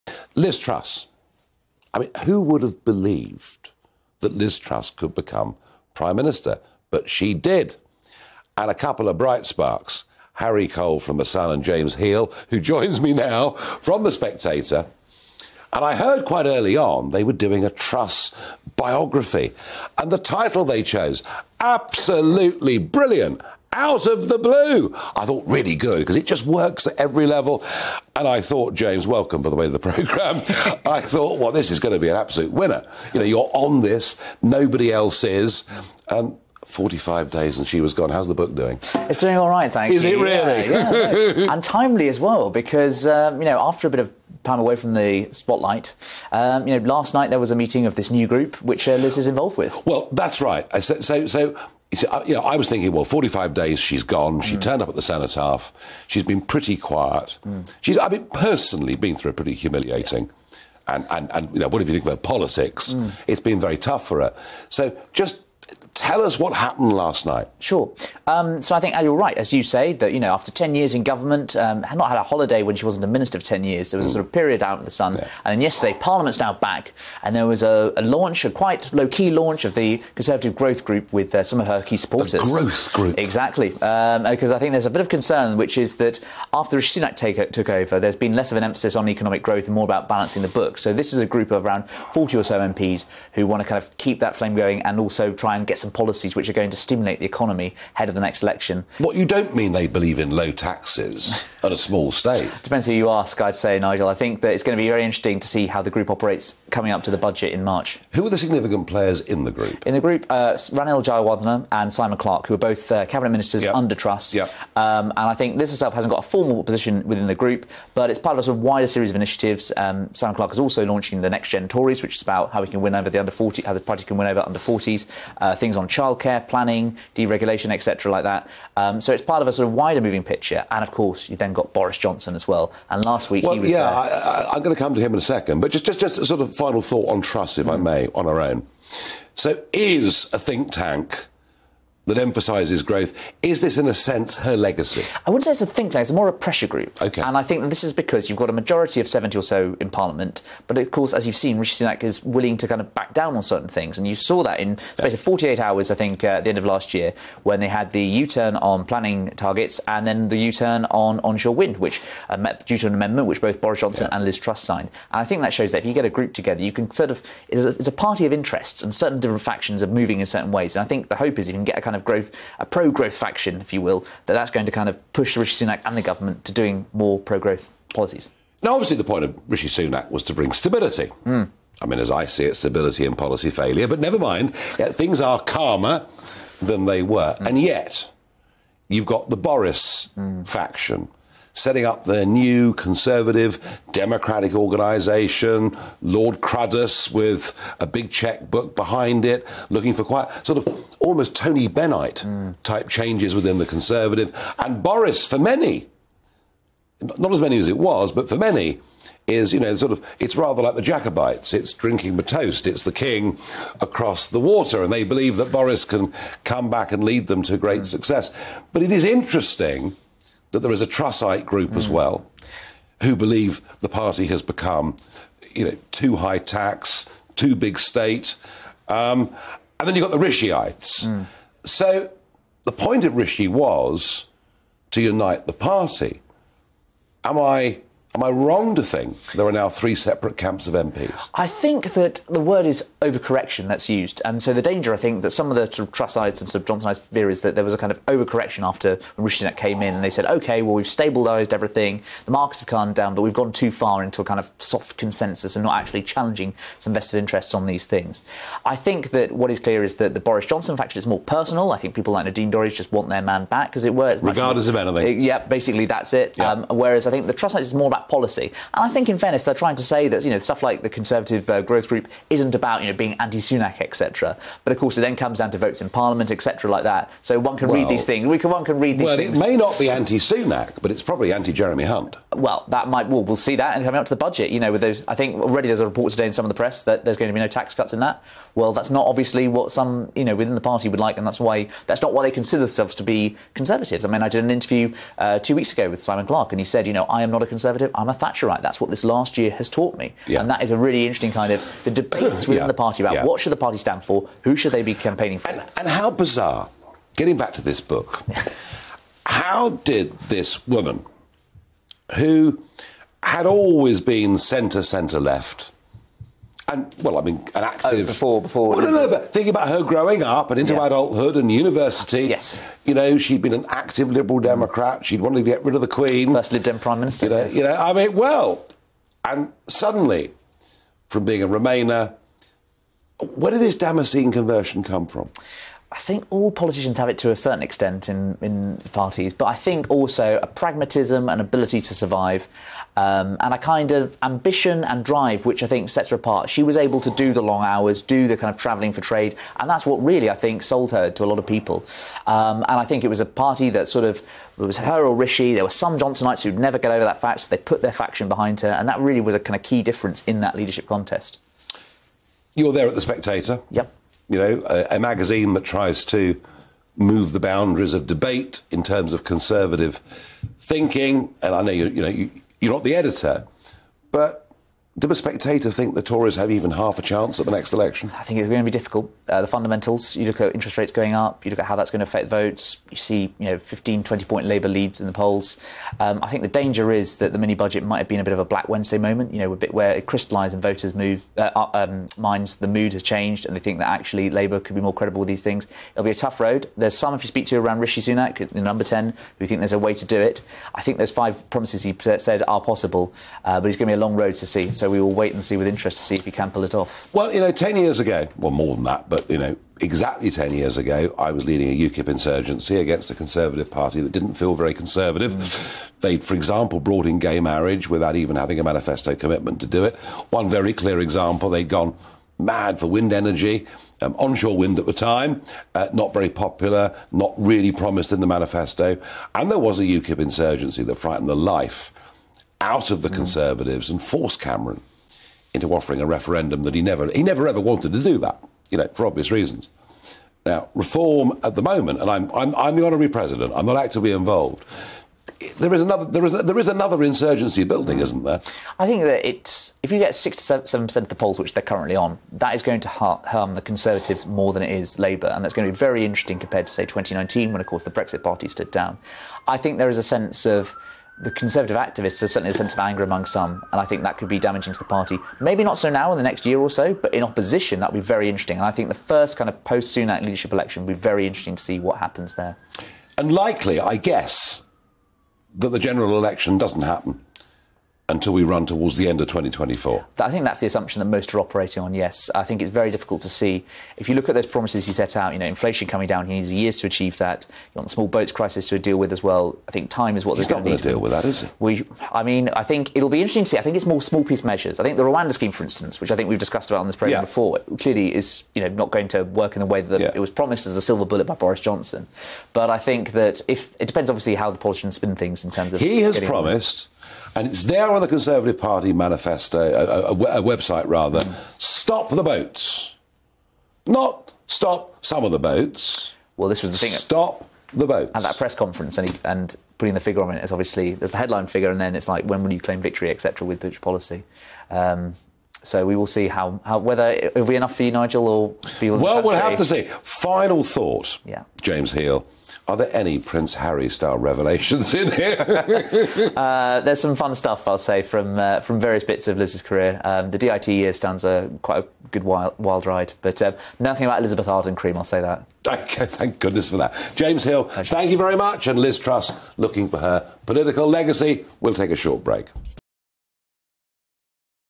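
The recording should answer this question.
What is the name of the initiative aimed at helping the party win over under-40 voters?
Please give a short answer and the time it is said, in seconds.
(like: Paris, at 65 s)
Next Gen Tories, at 121 s.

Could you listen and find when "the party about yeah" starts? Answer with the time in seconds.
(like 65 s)
302 s.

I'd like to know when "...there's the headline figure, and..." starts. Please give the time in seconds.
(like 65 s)
520 s.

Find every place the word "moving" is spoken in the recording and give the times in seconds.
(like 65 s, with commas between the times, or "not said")
130 s, 169 s.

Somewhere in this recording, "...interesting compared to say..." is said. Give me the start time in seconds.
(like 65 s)
456 s.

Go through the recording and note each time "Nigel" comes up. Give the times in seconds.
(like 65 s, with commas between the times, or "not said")
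103 s, 527 s.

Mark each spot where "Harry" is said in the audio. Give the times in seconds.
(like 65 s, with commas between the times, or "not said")
10 s, 533 s.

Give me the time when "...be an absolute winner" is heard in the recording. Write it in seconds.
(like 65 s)
31 s.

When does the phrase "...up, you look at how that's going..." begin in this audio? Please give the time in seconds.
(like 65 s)
381 s.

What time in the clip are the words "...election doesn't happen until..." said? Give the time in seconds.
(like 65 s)
476 s.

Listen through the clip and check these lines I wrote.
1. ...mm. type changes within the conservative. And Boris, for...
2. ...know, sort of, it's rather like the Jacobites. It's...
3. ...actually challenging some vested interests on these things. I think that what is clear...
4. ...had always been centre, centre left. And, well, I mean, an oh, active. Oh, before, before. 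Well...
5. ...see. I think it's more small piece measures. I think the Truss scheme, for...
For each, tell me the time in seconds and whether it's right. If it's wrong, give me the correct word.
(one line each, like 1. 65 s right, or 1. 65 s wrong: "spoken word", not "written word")
1. 202 s right
2. 209 s right
3. 255 s right
4. 313 s right
5. 493 s wrong: "Rwanda", not "Truss".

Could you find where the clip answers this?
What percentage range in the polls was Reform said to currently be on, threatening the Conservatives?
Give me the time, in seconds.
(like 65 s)
450 s.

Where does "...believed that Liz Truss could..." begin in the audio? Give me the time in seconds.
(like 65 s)
2 s.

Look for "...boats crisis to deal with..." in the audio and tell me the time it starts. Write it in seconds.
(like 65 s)
488 s.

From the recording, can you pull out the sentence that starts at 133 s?
Yeah, I, am going to come to him in a second.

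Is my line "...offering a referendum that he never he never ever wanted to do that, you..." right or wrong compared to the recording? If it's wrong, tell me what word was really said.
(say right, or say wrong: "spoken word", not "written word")
right.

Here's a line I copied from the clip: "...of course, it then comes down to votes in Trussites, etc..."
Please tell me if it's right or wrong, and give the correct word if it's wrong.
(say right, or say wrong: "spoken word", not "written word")
wrong: "Parliament", not "Trussites".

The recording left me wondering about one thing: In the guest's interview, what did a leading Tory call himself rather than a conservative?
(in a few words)
a Thatcherite.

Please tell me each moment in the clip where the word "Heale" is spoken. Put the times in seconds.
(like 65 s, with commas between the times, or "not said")
11 s, 531 s, 547 s.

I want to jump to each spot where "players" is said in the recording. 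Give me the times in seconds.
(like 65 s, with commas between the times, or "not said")
108 s.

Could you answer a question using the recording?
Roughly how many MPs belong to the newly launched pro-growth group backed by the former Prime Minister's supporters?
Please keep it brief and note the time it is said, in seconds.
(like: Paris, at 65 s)
around 40, at 91 s.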